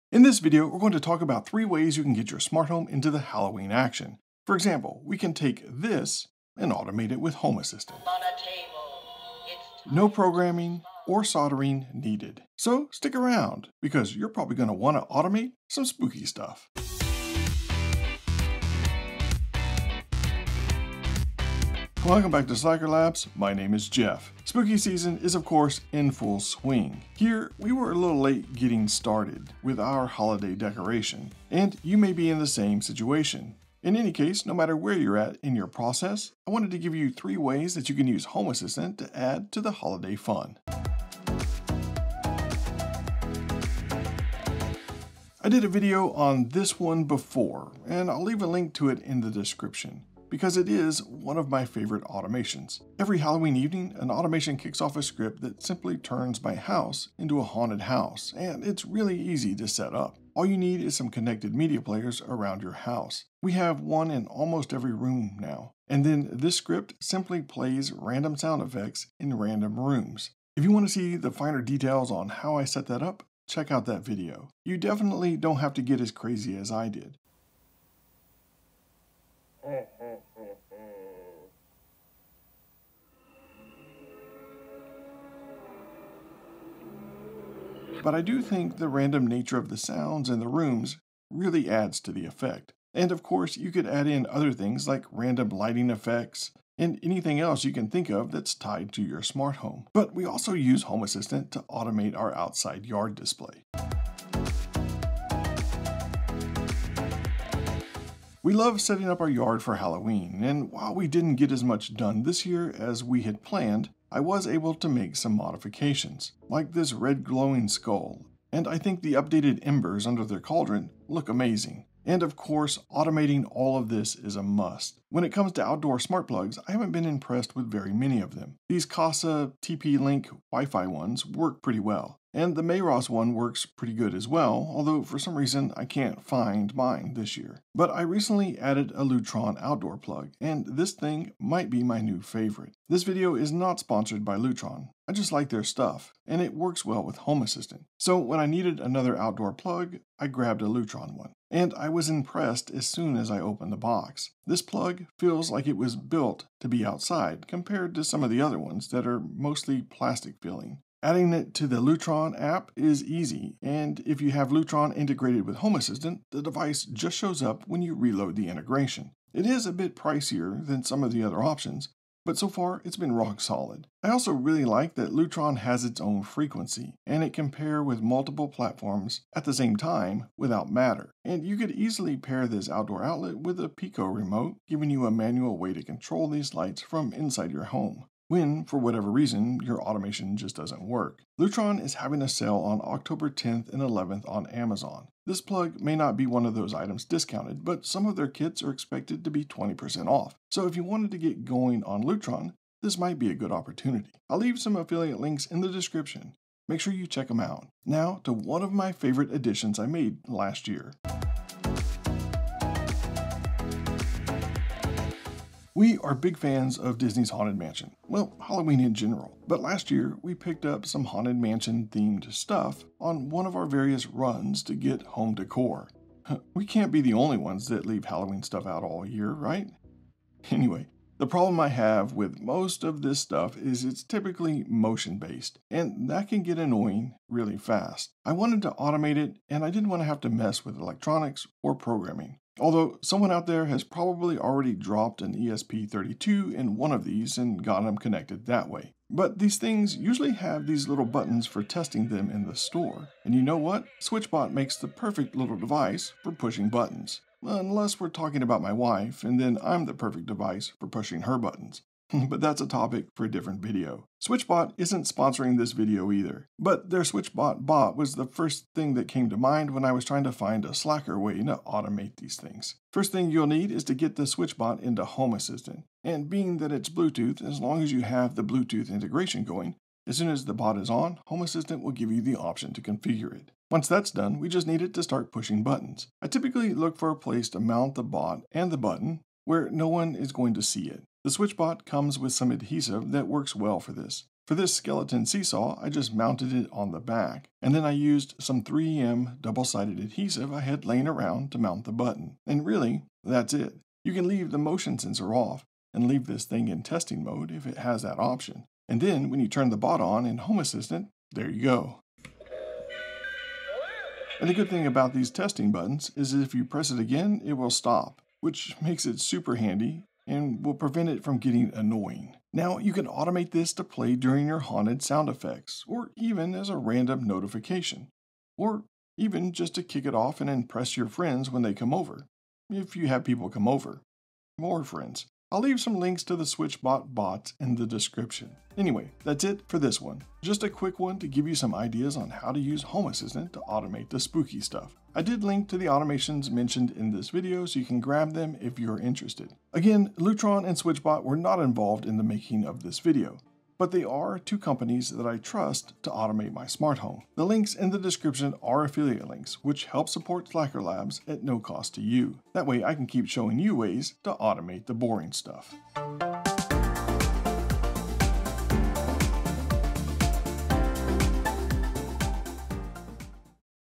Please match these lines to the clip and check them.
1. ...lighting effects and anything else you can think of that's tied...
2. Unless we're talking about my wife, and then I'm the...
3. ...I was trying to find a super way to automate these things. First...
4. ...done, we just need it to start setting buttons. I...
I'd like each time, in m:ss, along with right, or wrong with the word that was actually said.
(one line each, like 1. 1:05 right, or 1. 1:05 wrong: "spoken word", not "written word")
1. 1:35 right
2. 4:17 right
3. 4:29 wrong: "slacker", not "super"
4. 4:44 wrong: "pushing", not "setting".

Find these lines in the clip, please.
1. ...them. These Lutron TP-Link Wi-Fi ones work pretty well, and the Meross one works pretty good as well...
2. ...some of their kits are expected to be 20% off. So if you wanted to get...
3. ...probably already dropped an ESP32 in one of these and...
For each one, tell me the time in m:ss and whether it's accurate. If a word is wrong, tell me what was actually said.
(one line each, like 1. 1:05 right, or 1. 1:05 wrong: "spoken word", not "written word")
1. 2:08 wrong: "Kasa", not "Lutron"
2. 3:17 right
3. 4:03 right.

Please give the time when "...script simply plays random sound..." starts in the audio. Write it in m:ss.
1:06.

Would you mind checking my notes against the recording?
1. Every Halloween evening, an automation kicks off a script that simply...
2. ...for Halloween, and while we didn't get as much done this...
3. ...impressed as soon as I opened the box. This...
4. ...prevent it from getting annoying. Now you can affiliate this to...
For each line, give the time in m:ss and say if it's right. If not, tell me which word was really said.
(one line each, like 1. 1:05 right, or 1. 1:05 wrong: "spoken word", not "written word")
1. 0:52 right
2. 1:49 right
3. 2:32 right
4. 5:20 wrong: "automate", not "affiliate".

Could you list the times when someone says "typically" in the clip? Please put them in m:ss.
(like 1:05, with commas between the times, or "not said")
3:54, 4:46.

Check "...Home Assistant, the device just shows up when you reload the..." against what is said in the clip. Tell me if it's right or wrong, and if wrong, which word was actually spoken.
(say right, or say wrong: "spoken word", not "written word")
right.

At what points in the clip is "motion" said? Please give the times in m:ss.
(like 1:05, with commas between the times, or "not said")
3:54, 5:04.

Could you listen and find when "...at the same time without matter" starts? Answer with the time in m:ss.
2:59.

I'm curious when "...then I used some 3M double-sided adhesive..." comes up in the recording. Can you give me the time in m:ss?
4:57.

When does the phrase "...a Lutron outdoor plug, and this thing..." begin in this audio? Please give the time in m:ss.
2:18.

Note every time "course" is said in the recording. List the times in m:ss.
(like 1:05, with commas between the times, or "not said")
0:25, 1:33, 2:02.